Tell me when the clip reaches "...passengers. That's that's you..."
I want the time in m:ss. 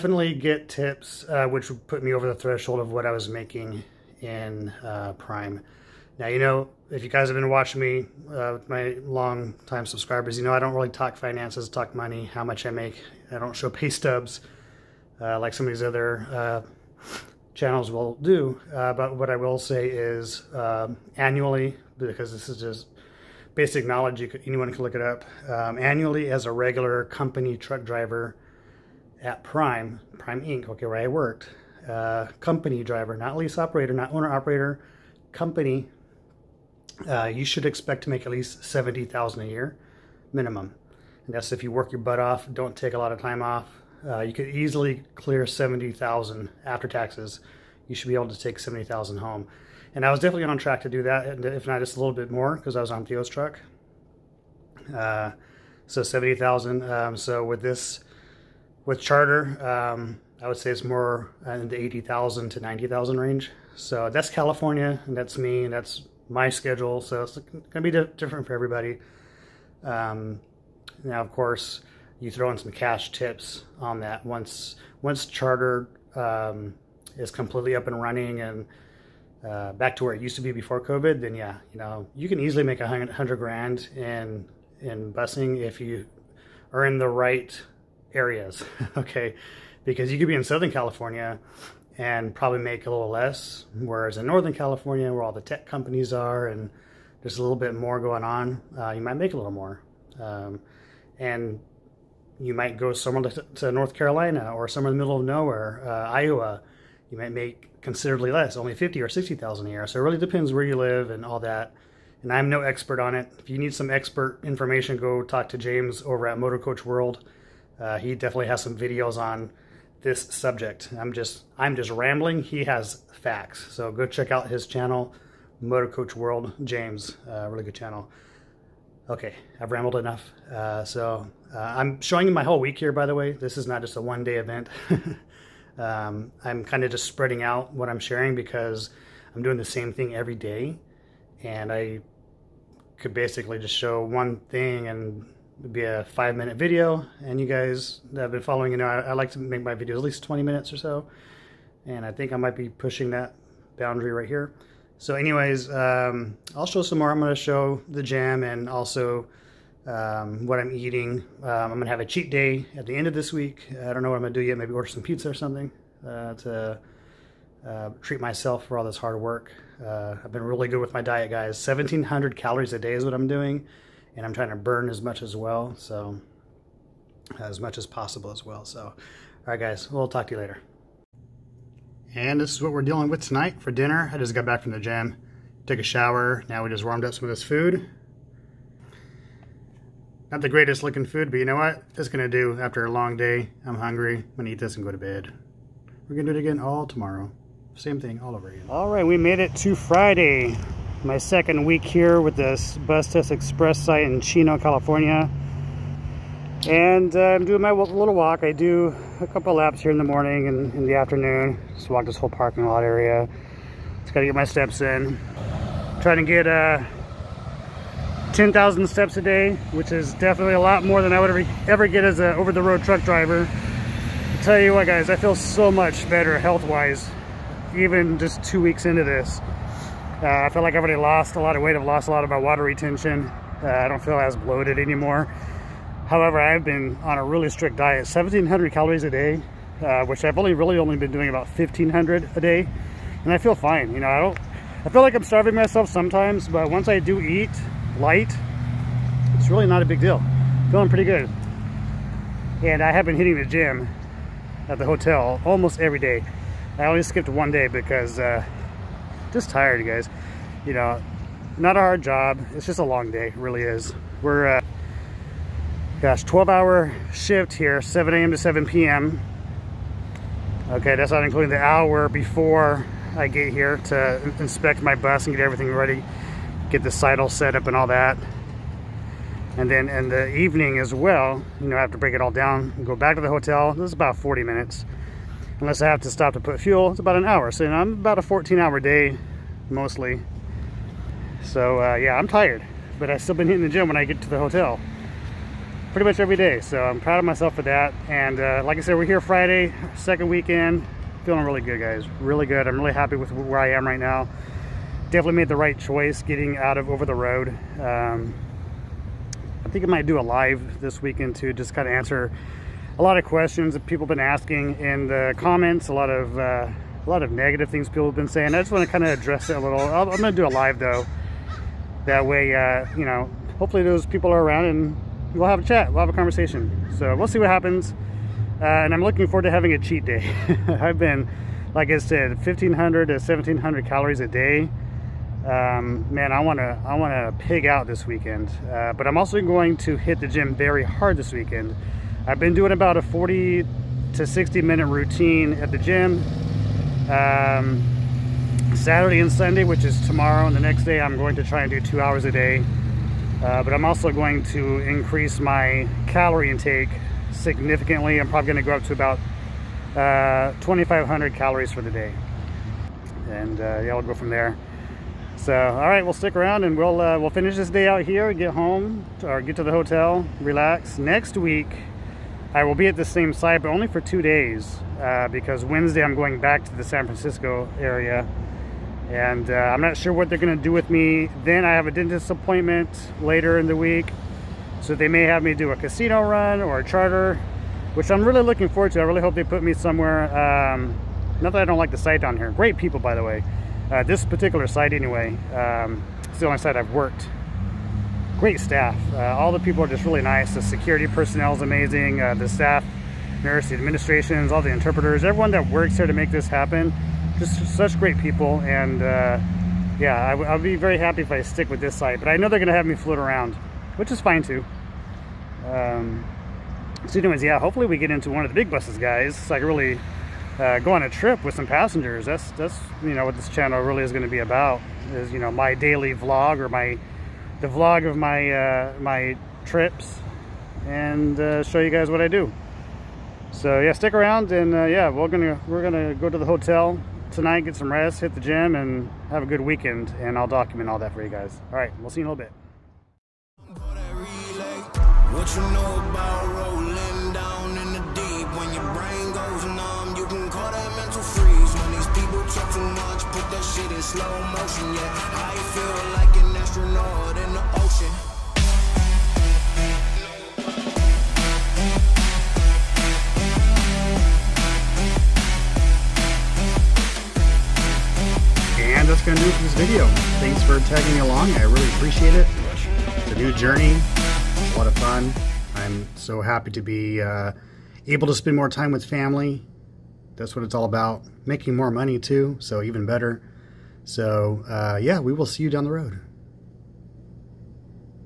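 7:01.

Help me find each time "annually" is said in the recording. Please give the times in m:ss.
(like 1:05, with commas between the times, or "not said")
0:21, 0:25.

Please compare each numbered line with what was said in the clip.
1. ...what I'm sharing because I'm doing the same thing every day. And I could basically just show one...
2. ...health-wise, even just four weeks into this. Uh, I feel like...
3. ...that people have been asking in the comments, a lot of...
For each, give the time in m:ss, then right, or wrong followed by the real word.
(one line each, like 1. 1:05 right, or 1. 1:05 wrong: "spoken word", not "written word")
1. 2:17 right
2. 3:46 wrong: "two", not "four"
3. 5:13 right.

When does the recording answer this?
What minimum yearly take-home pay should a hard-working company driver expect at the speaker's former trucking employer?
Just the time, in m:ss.
0:38.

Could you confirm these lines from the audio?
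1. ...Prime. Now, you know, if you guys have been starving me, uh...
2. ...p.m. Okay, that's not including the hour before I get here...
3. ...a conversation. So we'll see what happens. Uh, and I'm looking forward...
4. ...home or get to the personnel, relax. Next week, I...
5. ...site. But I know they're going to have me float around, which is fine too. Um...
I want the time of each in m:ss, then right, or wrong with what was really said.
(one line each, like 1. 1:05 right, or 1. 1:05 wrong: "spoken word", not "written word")
1. 0:05 wrong: "watching", not "starving"
2. 4:28 right
3. 5:26 right
4. 6:08 wrong: "hotel", not "personnel"
5. 6:51 right.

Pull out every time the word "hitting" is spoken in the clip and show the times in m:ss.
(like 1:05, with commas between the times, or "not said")
4:13, 4:53.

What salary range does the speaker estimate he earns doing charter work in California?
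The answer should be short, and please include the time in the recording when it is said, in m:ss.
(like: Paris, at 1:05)
80,000 to 90,000, at 1:01.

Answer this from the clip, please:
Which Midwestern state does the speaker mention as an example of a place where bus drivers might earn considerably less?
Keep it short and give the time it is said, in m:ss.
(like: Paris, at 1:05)
Iowa, at 1:46.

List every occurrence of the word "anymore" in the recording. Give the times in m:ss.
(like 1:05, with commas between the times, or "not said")
3:54.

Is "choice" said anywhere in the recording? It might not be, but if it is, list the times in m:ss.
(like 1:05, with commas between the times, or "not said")
5:05.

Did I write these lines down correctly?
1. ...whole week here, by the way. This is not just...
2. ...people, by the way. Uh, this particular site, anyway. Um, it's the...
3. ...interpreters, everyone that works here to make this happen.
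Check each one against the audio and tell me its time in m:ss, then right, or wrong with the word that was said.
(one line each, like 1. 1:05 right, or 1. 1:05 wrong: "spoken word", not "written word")
1. 2:12 right
2. 6:32 right
3. 6:44 right.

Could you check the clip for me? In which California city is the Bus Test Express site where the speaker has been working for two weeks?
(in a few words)
Chino.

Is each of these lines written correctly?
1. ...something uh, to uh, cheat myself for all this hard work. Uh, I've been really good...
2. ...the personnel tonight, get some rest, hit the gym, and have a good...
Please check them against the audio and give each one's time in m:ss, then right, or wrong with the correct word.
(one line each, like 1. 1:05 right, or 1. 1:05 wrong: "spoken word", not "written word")
1. 2:45 wrong: "treat", not "cheat"
2. 7:16 wrong: "hotel", not "personnel".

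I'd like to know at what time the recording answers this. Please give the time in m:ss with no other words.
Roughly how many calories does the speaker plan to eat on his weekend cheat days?
6:00.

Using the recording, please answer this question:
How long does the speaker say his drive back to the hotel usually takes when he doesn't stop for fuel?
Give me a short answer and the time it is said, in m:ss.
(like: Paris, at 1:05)
40 minutes, at 4:43.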